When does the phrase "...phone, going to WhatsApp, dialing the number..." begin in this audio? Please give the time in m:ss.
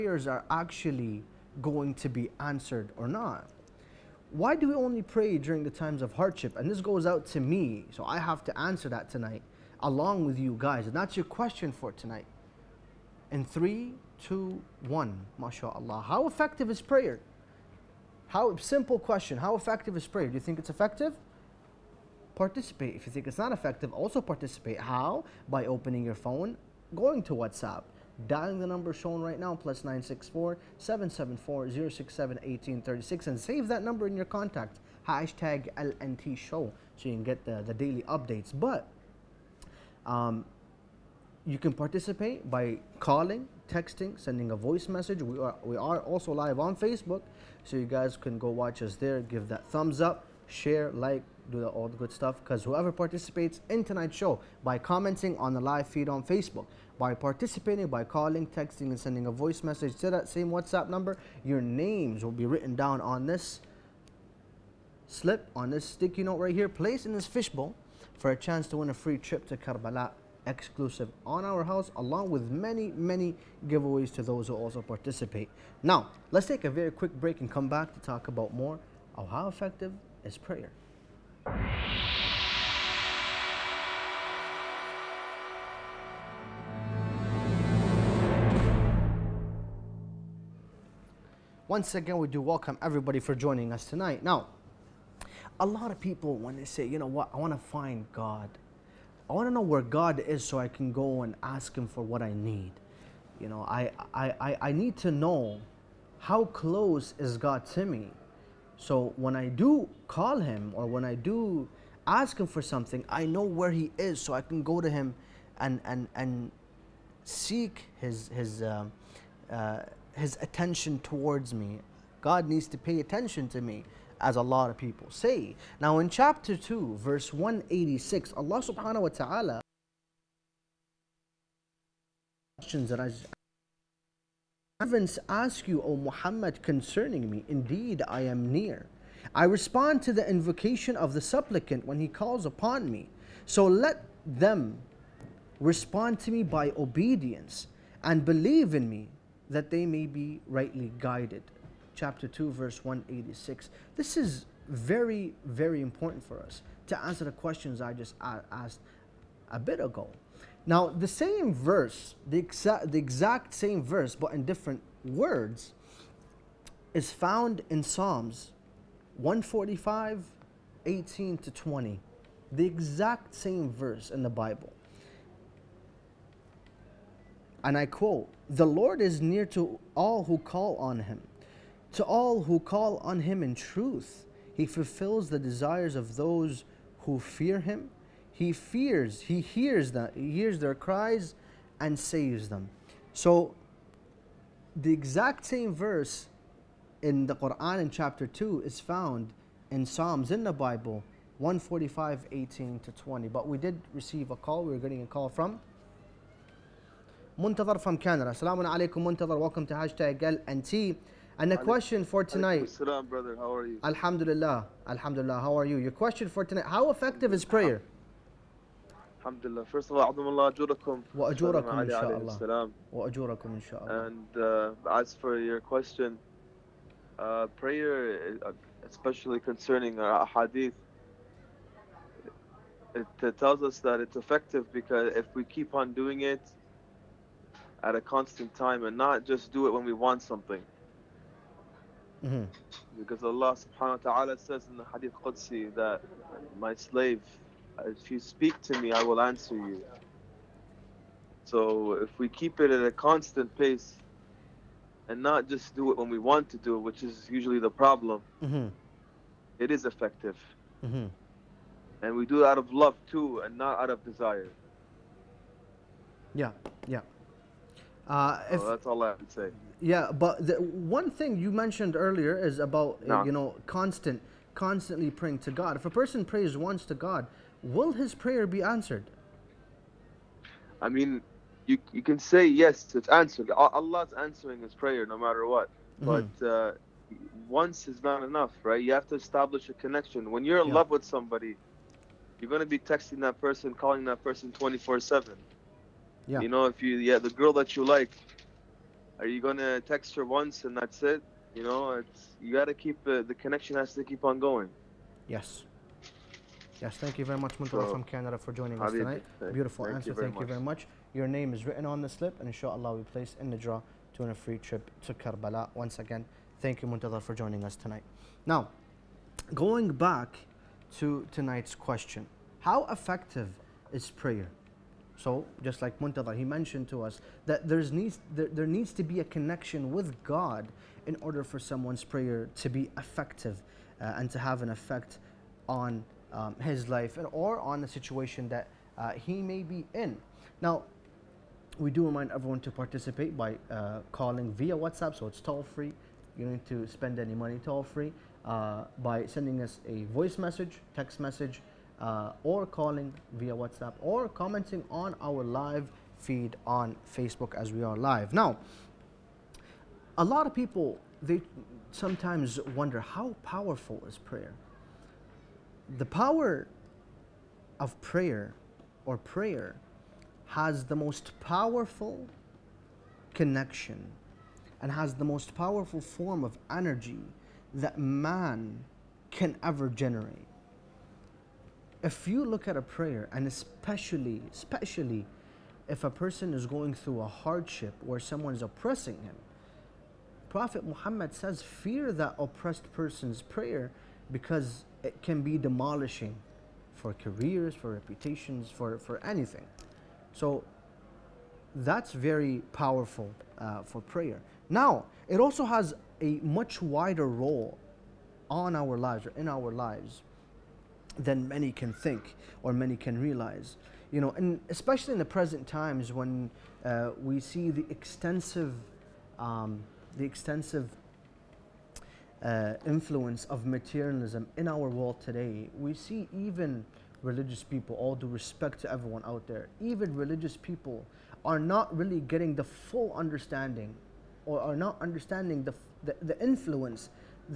0:26.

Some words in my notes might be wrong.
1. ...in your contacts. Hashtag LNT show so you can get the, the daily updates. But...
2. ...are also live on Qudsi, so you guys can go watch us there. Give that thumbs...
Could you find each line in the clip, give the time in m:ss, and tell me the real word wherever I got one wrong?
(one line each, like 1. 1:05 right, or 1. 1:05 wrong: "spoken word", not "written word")
1. 0:34 right
2. 0:45 wrong: "Facebook", not "Qudsi".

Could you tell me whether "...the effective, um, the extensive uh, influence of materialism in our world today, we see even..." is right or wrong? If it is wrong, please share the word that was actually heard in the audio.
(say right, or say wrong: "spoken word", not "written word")
wrong: "extensive", not "effective".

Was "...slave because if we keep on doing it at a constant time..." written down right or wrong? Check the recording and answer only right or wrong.
wrong.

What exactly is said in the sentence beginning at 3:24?
We were getting a call from Muntadar from Canada.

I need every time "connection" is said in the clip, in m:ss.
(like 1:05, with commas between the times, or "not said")
4:49, 5:03, 5:29, 6:13.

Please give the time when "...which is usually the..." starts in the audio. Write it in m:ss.
4:16.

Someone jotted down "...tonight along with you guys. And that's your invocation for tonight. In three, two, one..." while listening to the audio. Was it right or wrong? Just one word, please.
wrong.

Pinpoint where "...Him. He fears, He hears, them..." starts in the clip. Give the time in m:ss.
3:07.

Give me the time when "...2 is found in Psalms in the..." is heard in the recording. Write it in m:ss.
3:18.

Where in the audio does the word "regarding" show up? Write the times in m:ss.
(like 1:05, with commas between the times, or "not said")
not said.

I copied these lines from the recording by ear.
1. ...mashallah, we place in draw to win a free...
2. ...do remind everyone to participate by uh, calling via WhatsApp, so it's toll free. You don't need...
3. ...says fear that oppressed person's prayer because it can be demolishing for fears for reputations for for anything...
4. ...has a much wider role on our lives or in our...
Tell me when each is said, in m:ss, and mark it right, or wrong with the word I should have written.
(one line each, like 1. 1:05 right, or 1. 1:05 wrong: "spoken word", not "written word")
1. 5:12 wrong: "inshallah", not "mashallah"
2. 5:41 right
3. 6:31 wrong: "careers", not "fears"
4. 6:45 right.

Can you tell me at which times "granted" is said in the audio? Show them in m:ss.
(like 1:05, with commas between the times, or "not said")
not said.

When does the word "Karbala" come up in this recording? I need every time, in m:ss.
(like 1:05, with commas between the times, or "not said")
1:09, 5:15.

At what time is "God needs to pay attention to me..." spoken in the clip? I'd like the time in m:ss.
2:02.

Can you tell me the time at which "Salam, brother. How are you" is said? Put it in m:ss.
3:32.